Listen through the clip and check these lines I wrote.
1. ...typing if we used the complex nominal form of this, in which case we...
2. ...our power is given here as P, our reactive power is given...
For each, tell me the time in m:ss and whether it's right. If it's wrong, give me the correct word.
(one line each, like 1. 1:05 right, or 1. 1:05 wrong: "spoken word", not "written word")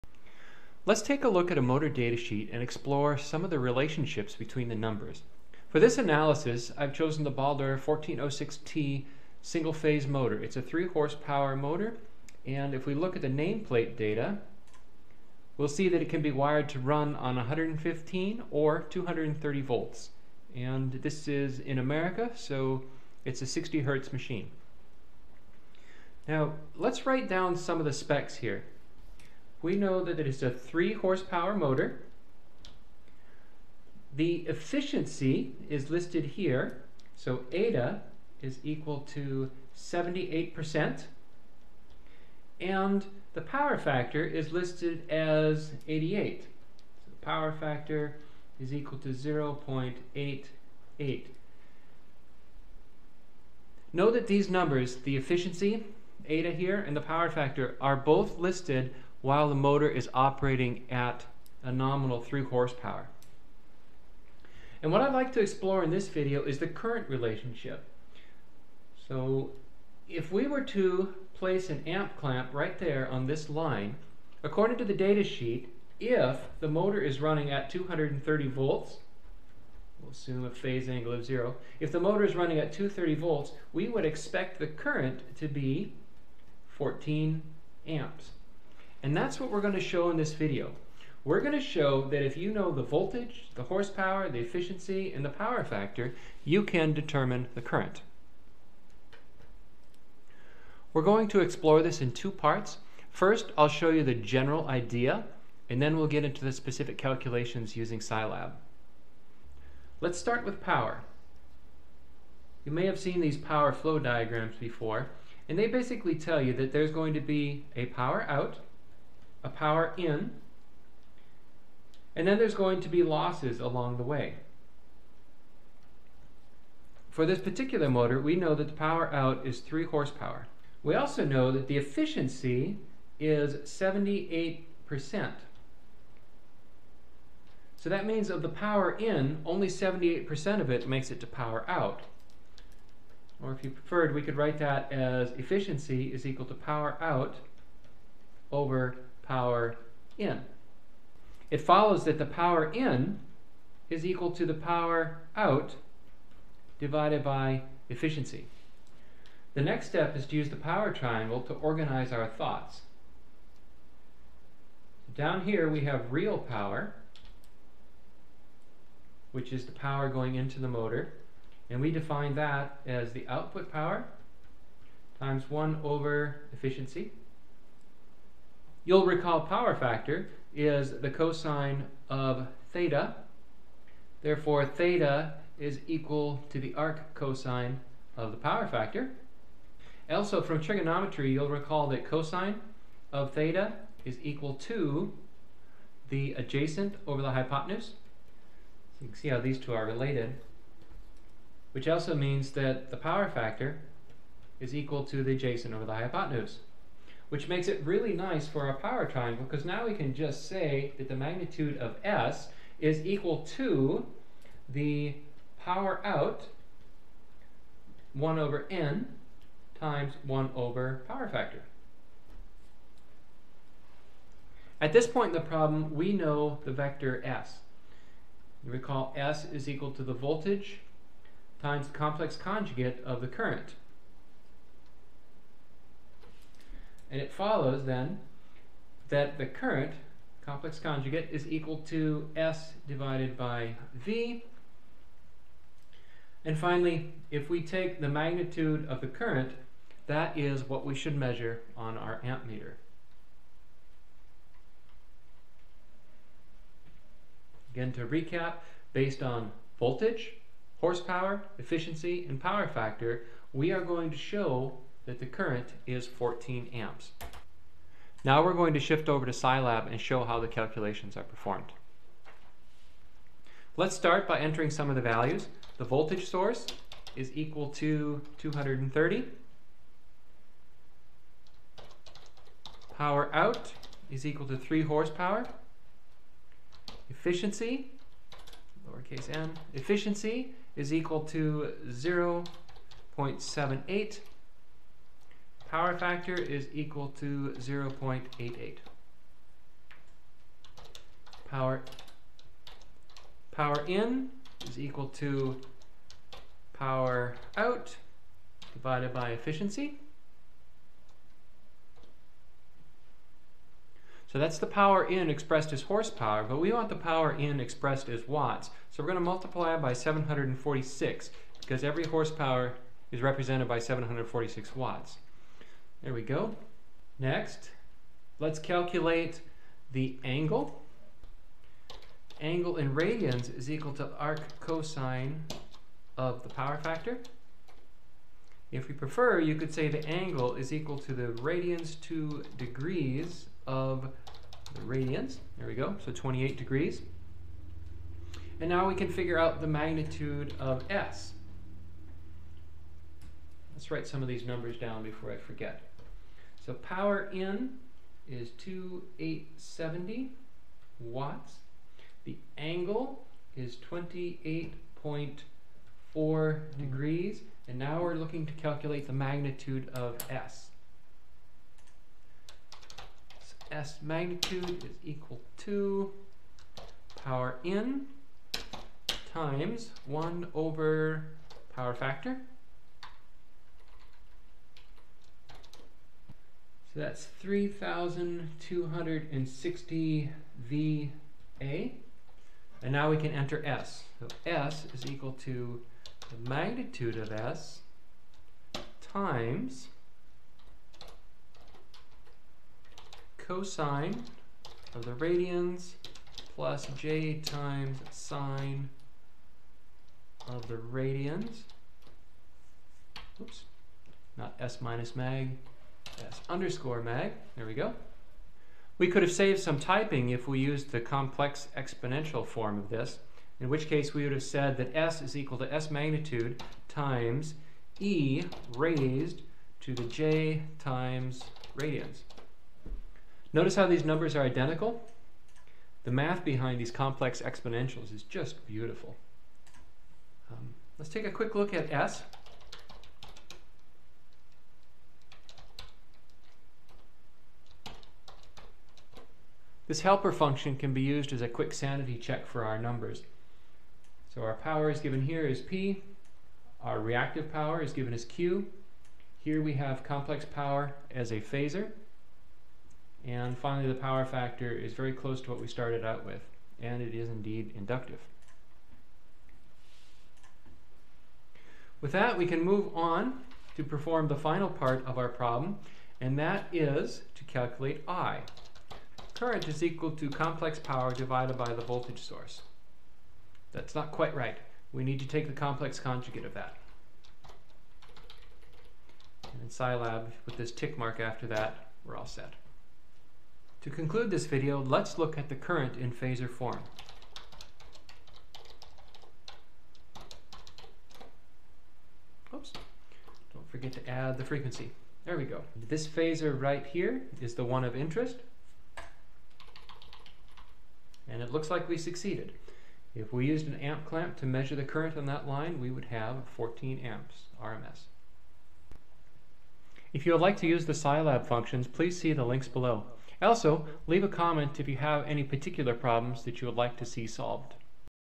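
1. 6:59 wrong: "exponential", not "nominal"
2. 7:34 right.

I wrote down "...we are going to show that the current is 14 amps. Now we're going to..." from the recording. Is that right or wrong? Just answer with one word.
right.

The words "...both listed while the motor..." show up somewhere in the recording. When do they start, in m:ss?
0:57.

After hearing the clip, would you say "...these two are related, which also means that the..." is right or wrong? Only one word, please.
right.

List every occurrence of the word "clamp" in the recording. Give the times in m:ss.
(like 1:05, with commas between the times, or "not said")
1:12, 8:34.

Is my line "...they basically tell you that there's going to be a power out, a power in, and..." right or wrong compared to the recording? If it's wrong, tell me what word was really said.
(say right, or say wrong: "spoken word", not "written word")
right.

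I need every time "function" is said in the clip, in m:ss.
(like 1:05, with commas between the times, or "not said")
7:30, 8:41.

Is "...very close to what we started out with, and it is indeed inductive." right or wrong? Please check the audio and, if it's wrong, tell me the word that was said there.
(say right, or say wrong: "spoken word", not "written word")
right.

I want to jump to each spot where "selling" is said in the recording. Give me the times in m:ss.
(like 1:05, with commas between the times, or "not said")
not said.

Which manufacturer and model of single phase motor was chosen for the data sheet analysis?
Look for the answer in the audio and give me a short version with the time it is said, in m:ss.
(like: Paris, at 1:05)
Baldor 1406T, at 0:07.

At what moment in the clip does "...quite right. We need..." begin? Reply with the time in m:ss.
8:04.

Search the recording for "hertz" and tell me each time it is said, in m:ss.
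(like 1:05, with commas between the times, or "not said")
0:23.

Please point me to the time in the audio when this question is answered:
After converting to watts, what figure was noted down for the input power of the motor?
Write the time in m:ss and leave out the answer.
5:58.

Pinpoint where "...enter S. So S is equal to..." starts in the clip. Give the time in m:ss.
6:33.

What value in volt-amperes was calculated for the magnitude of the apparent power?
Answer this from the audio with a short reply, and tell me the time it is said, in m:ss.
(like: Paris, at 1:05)
3,260 VA, at 6:27.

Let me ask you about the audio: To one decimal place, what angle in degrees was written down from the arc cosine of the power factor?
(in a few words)
28.4.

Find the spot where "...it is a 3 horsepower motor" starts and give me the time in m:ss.
0:30.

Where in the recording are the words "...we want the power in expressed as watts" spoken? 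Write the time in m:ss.
5:16.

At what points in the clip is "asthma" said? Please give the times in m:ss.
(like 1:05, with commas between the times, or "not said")
not said.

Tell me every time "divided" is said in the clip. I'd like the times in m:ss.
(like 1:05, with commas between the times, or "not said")
2:36, 4:02, 5:08, 8:01.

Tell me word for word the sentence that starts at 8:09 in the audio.
And in Scilab, with this tick mark after that, we're all set.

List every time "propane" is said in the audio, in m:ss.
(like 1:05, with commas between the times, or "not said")
not said.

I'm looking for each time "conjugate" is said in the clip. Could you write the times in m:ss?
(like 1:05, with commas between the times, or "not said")
3:52, 4:00, 8:05.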